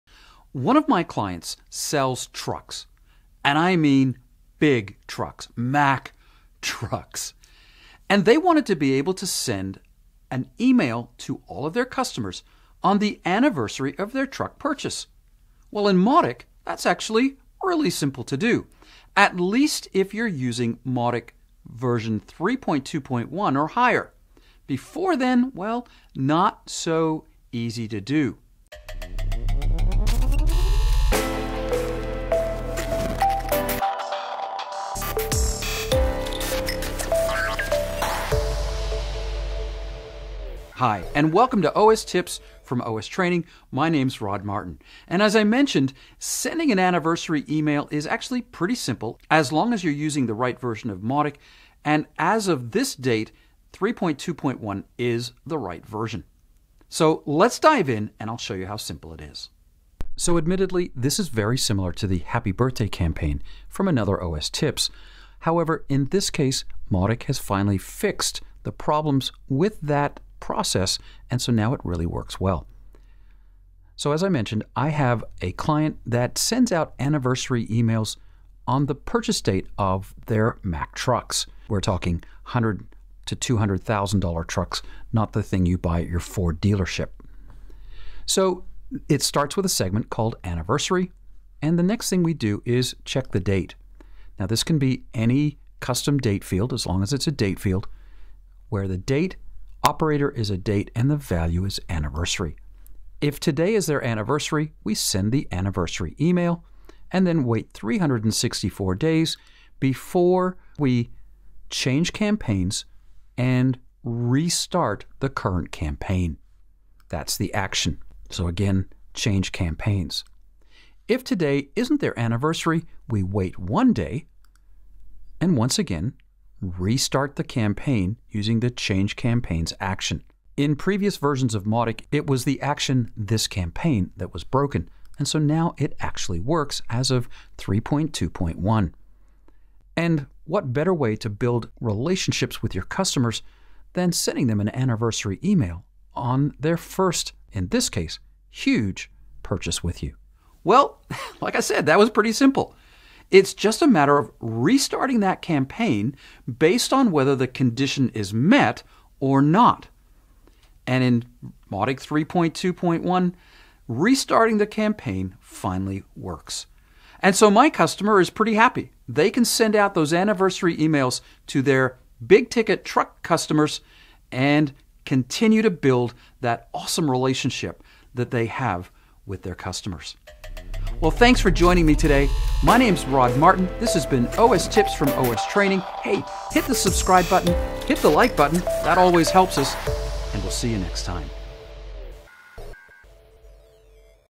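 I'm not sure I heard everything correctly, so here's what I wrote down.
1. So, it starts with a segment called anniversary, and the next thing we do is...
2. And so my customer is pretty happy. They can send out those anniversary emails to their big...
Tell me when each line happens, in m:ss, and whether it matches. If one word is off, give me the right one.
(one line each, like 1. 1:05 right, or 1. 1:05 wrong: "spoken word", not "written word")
1. 1:28 right
2. 2:47 right.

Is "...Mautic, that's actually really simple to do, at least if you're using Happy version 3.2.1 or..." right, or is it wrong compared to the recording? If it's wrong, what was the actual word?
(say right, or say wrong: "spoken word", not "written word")
wrong: "Mautic", not "Happy".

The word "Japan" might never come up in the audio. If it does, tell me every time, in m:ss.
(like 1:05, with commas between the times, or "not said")
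not said.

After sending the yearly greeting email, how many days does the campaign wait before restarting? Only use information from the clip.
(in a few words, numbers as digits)
364.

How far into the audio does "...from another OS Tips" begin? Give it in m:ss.
1:03.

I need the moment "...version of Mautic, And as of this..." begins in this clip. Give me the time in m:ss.
0:50.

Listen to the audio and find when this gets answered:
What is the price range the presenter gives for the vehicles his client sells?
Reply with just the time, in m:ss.
1:22.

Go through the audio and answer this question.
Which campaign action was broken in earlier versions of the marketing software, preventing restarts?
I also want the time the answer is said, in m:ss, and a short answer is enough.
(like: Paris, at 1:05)
This Campaign, at 2:13.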